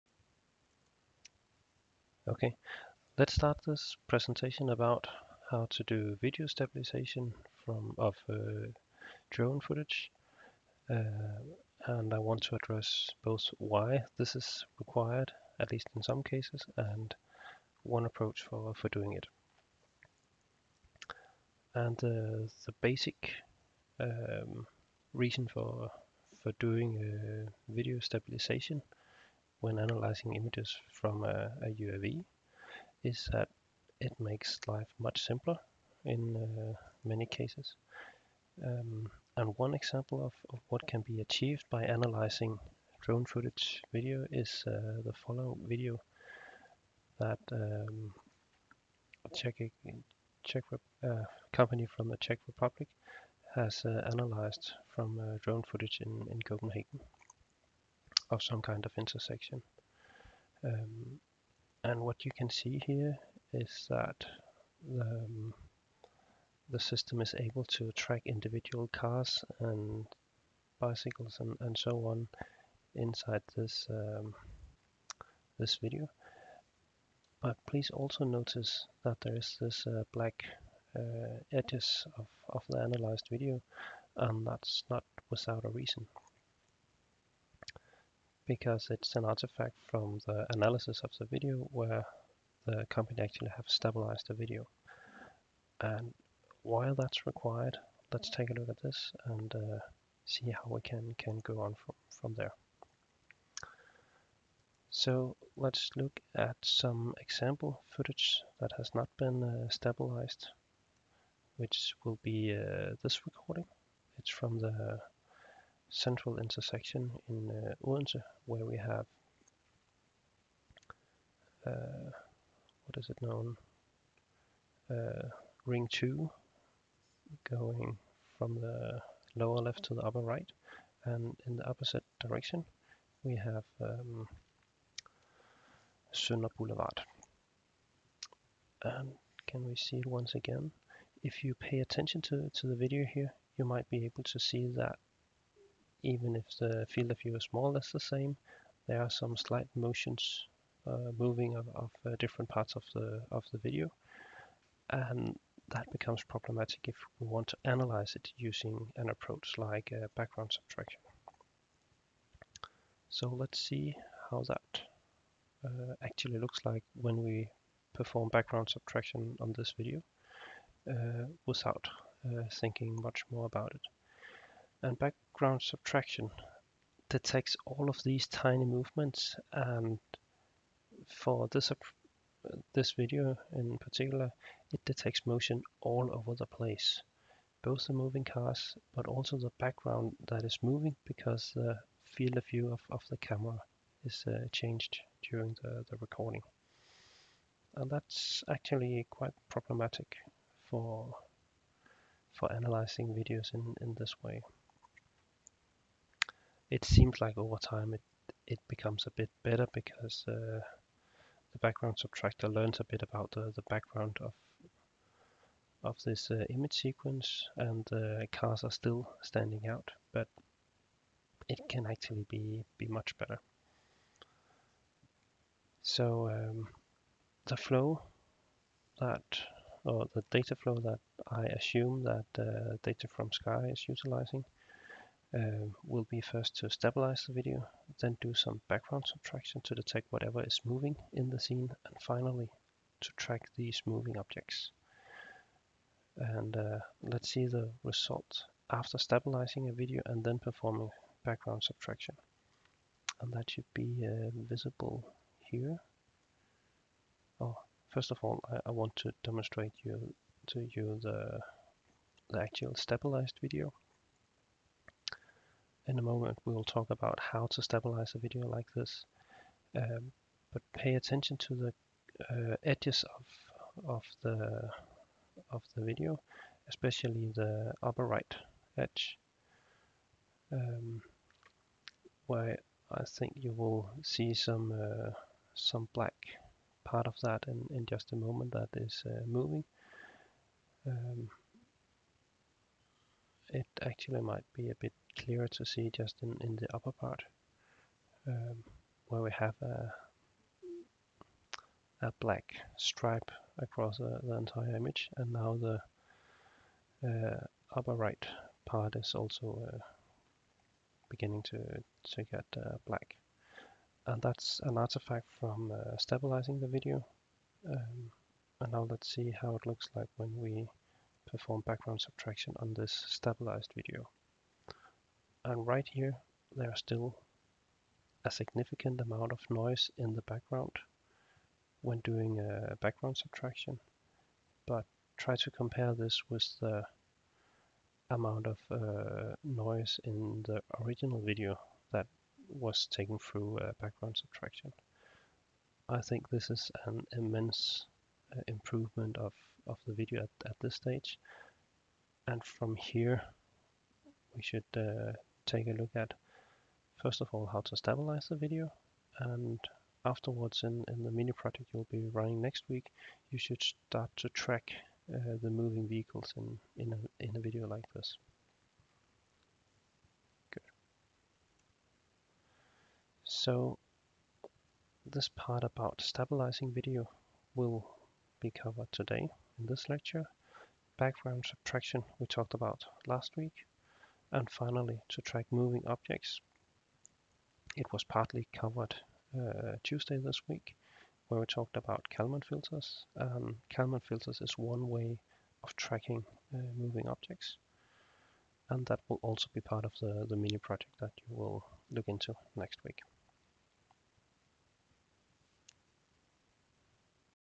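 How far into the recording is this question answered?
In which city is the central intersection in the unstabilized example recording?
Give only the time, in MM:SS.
01:57.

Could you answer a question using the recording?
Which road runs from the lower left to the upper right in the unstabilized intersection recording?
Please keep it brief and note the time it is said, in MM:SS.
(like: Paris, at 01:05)
Ring 2, at 02:05.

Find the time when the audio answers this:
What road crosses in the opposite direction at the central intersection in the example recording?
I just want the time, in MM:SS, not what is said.
02:16.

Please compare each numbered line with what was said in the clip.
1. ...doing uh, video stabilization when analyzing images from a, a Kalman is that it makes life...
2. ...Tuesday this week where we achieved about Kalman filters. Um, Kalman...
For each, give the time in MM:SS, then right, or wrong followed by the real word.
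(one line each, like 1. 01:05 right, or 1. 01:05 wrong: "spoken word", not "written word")
1. 00:26 wrong: "UAV", not "Kalman"
2. 06:29 wrong: "talked", not "achieved".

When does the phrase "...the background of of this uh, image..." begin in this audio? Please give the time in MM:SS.
03:33.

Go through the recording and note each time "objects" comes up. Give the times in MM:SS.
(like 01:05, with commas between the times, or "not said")
04:04, 06:25, 06:37.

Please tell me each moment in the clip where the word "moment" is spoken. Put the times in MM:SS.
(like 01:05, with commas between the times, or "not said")
04:26, 04:48.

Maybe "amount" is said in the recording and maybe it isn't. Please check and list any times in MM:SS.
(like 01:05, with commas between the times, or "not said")
05:29, 05:38.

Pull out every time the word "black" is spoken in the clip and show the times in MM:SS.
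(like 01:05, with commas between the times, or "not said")
01:20, 04:45, 05:02, 05:12.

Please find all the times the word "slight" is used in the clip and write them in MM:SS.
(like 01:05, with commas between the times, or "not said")
02:29.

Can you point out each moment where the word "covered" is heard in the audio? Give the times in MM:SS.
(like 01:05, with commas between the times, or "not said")
06:18, 06:28.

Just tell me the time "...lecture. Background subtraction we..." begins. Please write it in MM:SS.
06:19.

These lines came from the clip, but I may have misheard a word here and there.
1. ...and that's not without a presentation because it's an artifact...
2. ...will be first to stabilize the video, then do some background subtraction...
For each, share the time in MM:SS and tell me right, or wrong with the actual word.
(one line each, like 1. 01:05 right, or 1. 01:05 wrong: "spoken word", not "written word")
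1. 01:24 wrong: "reason", not "presentation"
2. 03:55 right.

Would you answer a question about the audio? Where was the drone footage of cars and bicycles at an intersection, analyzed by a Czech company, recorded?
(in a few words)
Copenhagen.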